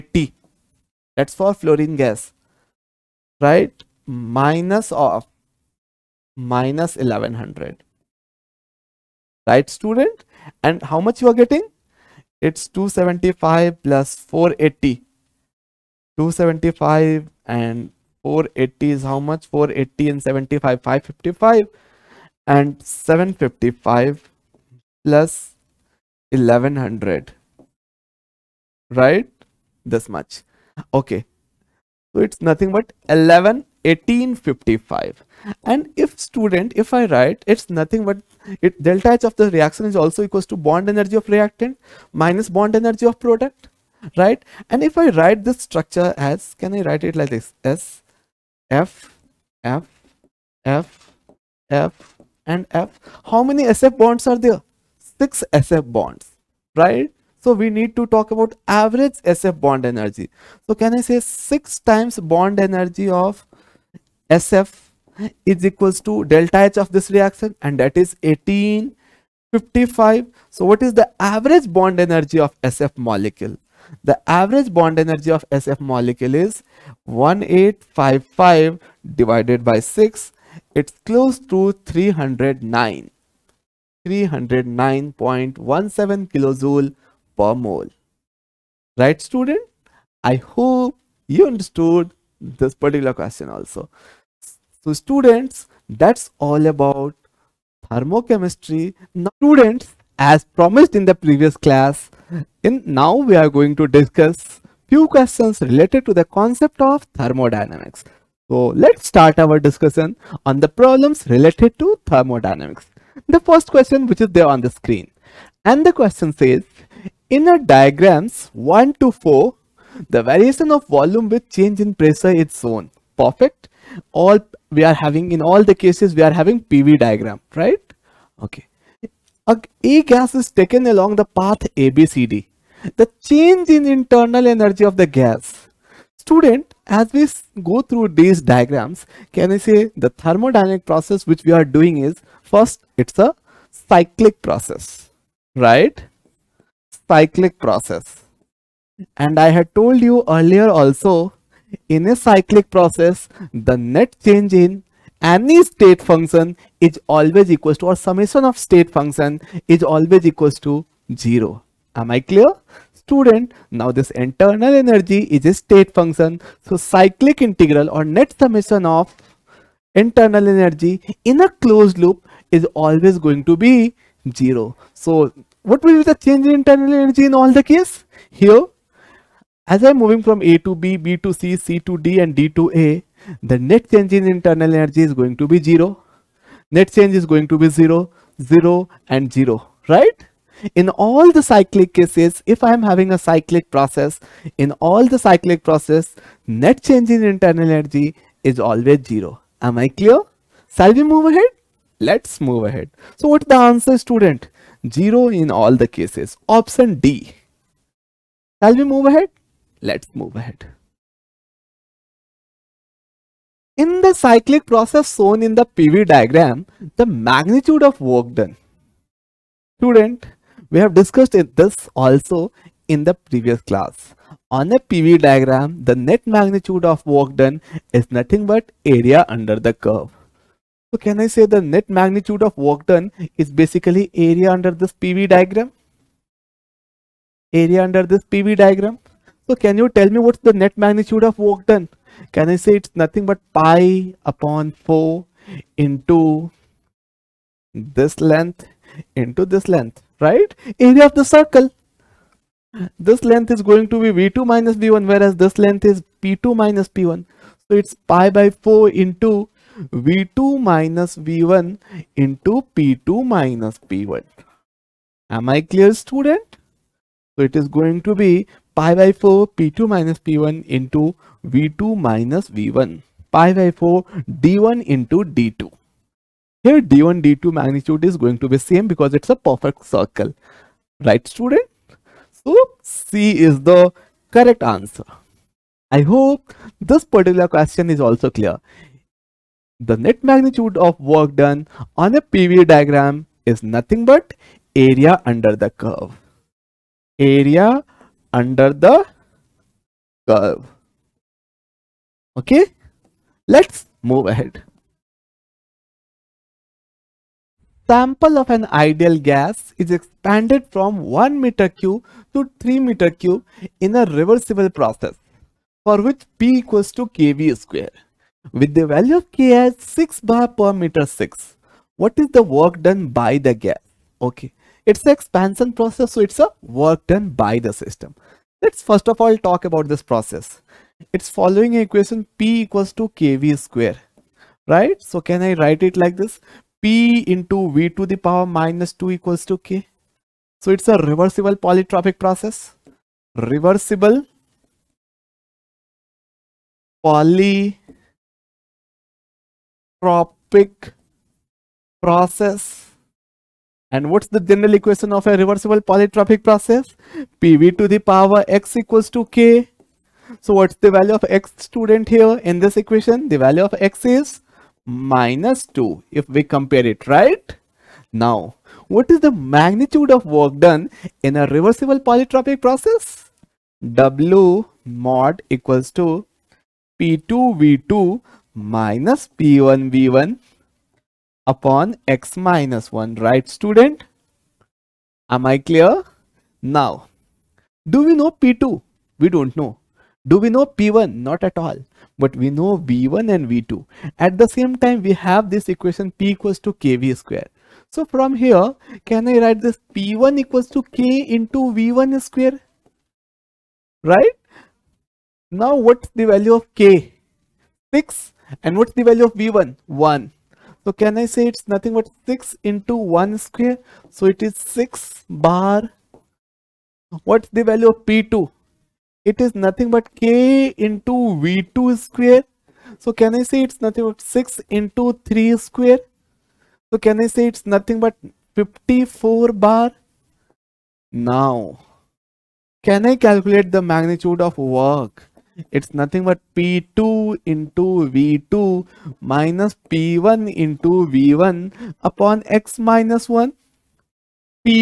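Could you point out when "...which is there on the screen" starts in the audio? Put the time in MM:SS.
01:54.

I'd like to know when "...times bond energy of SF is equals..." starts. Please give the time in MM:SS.
01:01.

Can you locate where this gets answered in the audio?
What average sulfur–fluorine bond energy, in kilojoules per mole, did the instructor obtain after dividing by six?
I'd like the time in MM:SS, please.
01:24.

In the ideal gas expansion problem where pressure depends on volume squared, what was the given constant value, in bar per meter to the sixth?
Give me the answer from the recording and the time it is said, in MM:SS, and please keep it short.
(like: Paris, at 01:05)
6, at 05:19.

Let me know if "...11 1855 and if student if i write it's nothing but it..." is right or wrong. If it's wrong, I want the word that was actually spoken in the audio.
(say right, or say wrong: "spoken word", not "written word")
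right.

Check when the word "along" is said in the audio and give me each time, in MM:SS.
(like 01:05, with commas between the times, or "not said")
02:10.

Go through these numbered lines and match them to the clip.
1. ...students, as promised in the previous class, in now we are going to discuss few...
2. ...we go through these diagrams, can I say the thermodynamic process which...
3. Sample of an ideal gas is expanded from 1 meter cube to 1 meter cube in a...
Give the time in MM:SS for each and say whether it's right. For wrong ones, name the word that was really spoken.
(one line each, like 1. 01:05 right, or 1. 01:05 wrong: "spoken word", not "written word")
1. 01:39 right
2. 02:17 right
3. 05:07 wrong: "3", not "1".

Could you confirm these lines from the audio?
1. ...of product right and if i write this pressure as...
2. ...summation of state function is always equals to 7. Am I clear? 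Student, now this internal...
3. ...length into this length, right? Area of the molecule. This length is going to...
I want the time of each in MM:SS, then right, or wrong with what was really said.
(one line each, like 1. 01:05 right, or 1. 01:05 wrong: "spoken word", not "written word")
1. 00:43 wrong: "structure", not "pressure"
2. 02:37 wrong: "0", not "7"
3. 04:08 wrong: "circle", not "molecule".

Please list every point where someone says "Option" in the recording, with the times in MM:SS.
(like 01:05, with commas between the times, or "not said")
03:26.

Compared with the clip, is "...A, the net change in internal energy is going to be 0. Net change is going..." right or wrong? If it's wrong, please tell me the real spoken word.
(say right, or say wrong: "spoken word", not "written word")
right.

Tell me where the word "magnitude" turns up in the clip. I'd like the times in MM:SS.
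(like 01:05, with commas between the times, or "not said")
03:37, 03:46, 03:51, 04:00, 04:37, 04:50, 06:09, 07:13.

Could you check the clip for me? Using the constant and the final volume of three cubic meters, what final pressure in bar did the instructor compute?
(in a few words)
54.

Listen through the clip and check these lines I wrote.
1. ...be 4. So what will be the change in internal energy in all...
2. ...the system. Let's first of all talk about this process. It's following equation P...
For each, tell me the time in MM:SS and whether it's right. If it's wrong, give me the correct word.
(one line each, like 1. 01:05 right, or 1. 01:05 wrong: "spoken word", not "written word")
1. 02:53 wrong: "0", not "4"
2. 05:27 right.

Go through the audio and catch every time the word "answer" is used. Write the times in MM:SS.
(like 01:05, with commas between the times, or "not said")
03:23, 04:44.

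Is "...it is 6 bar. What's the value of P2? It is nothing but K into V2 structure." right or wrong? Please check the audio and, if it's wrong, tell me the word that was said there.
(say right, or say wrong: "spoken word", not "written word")
wrong: "square", not "structure".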